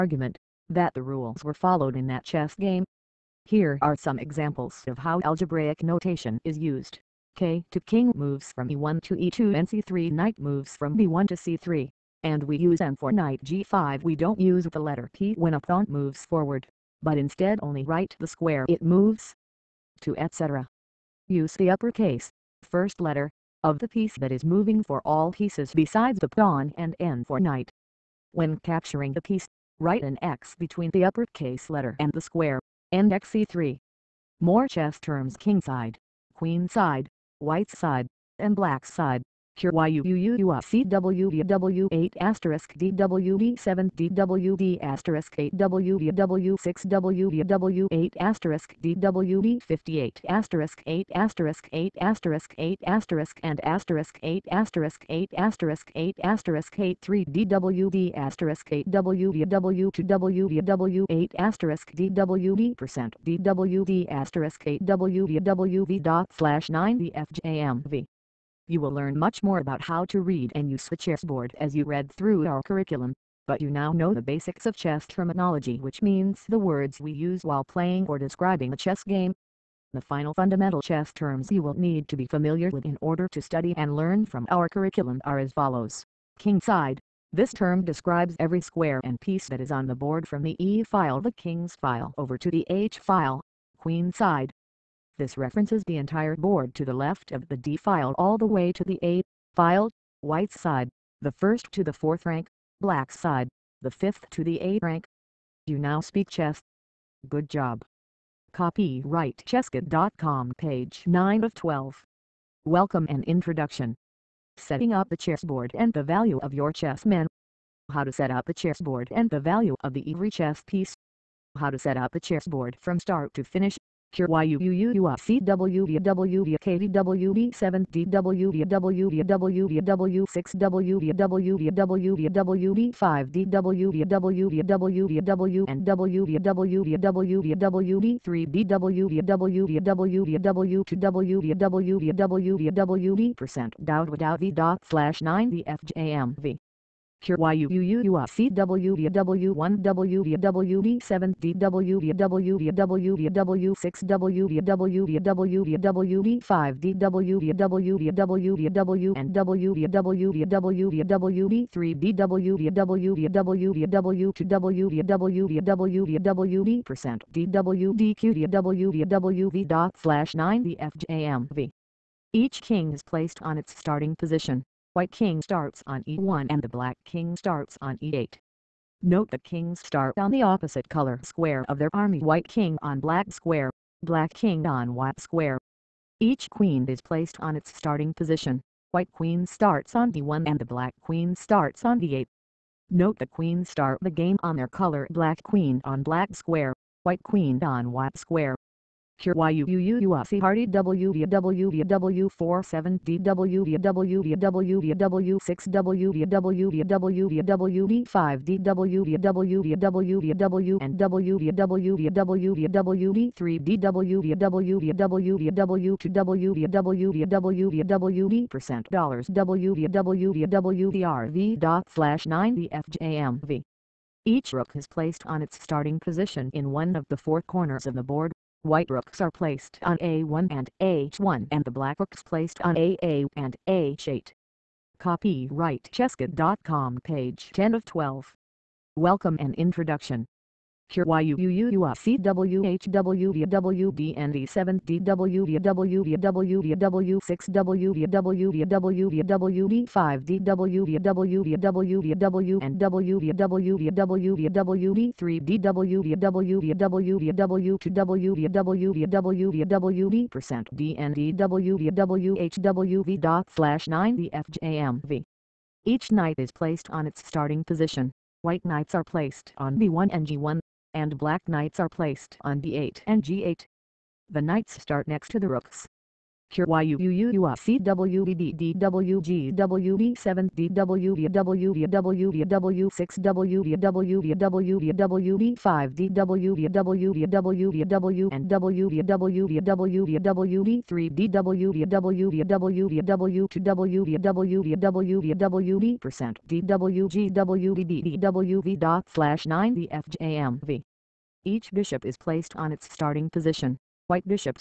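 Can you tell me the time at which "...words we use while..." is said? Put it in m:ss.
1:16.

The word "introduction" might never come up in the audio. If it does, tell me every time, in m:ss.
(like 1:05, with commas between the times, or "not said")
1:53, 3:59.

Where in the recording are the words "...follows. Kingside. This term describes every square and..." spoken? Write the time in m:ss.
1:25.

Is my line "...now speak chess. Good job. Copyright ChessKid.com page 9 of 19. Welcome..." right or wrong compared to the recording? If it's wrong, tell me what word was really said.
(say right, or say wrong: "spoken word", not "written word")
wrong: "12", not "19".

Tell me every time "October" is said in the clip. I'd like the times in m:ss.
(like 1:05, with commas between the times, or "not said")
not said.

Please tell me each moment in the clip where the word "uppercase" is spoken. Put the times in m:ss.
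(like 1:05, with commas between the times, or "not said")
0:21, 0:31.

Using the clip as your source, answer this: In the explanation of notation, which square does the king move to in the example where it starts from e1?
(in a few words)
e2.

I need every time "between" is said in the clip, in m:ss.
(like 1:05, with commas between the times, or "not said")
0:30.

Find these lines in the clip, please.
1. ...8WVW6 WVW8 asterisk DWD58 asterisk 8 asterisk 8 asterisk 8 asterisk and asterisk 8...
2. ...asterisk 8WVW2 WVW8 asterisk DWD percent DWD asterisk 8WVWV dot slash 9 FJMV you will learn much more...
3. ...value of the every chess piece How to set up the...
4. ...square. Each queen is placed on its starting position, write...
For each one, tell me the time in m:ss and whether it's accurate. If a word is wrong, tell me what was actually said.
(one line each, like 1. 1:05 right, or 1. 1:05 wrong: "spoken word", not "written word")
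1. 0:45 right
2. 0:58 right
3. 1:59 right
4. 3:05 wrong: "white", not "write".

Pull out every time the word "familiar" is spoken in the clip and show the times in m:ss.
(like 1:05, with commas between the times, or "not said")
1:22.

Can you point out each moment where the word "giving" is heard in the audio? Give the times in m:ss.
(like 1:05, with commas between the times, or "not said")
not said.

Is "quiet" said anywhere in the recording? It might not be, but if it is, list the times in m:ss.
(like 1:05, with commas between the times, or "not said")
not said.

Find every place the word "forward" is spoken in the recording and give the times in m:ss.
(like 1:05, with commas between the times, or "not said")
0:16.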